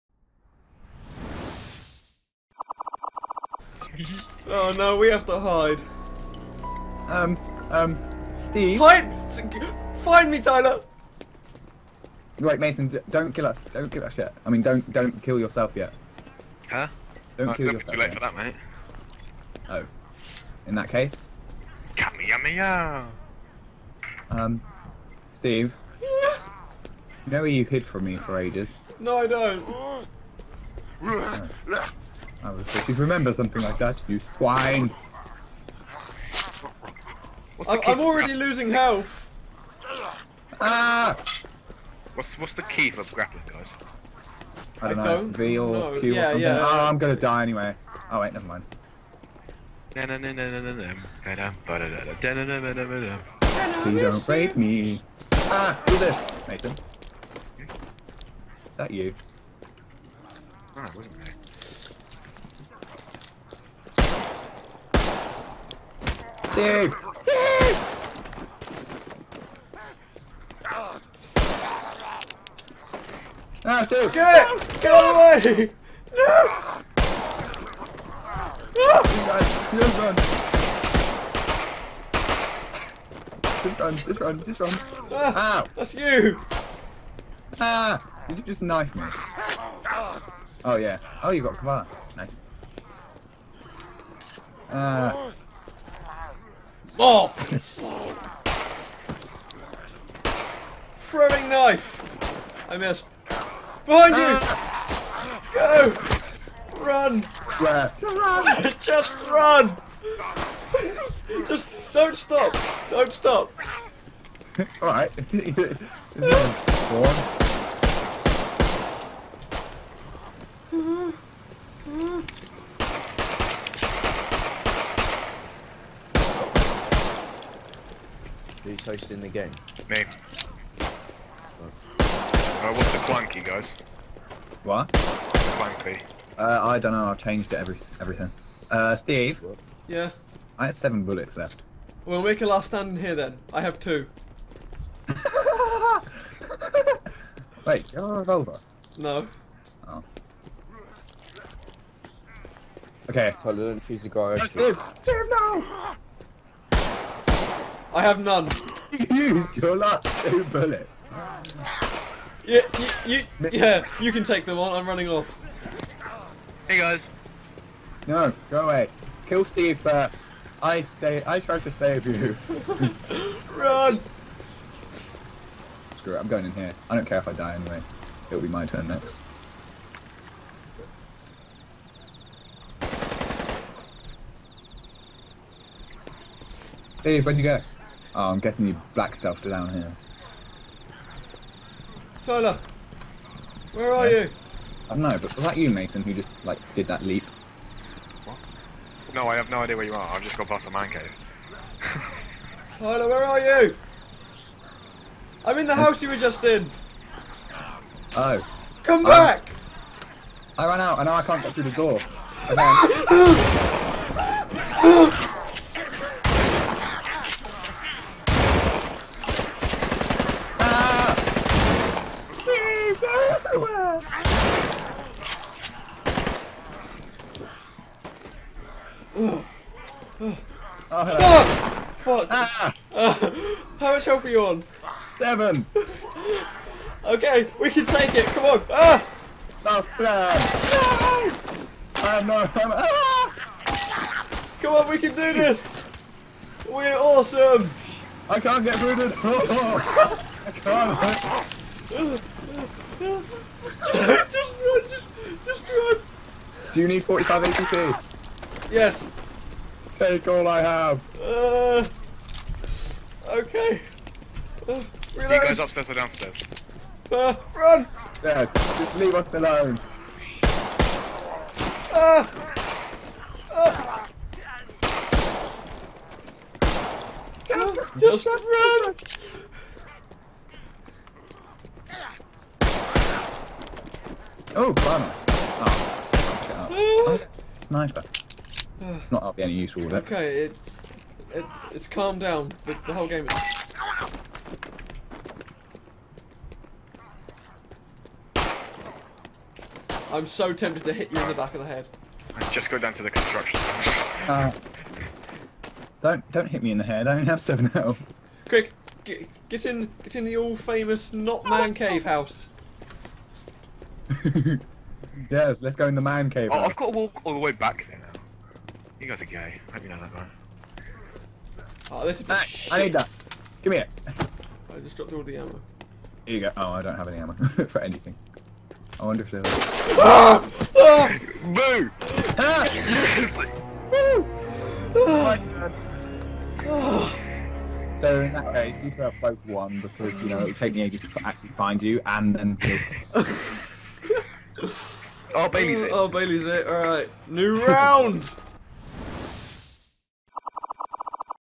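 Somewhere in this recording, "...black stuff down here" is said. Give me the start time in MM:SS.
03:08.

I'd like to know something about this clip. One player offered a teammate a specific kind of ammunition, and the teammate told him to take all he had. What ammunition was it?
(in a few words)
45 ACP.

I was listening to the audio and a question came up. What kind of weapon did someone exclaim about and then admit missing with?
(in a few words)
Throwing knife.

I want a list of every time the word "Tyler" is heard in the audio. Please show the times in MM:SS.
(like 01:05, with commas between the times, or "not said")
00:10, 02:33, 03:12, 03:22.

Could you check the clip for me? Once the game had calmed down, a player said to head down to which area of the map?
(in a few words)
The construction.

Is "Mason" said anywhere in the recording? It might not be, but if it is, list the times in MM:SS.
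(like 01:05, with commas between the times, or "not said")
00:12, 00:56, 03:15.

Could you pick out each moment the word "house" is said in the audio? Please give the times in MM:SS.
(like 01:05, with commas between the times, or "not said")
03:25, 05:12.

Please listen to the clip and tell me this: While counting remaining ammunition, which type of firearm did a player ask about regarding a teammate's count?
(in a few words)
Revolver.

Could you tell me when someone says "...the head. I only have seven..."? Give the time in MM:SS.
05:06.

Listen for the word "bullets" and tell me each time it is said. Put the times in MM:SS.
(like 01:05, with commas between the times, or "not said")
02:21, 02:40.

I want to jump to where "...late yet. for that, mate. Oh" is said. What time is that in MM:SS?
00:17.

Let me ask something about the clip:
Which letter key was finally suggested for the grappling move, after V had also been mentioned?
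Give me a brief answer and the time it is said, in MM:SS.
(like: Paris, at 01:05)
Q, at 00:45.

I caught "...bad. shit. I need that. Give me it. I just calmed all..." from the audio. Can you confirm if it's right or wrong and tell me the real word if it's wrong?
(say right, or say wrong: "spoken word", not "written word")
wrong: "dropped", not "calmed".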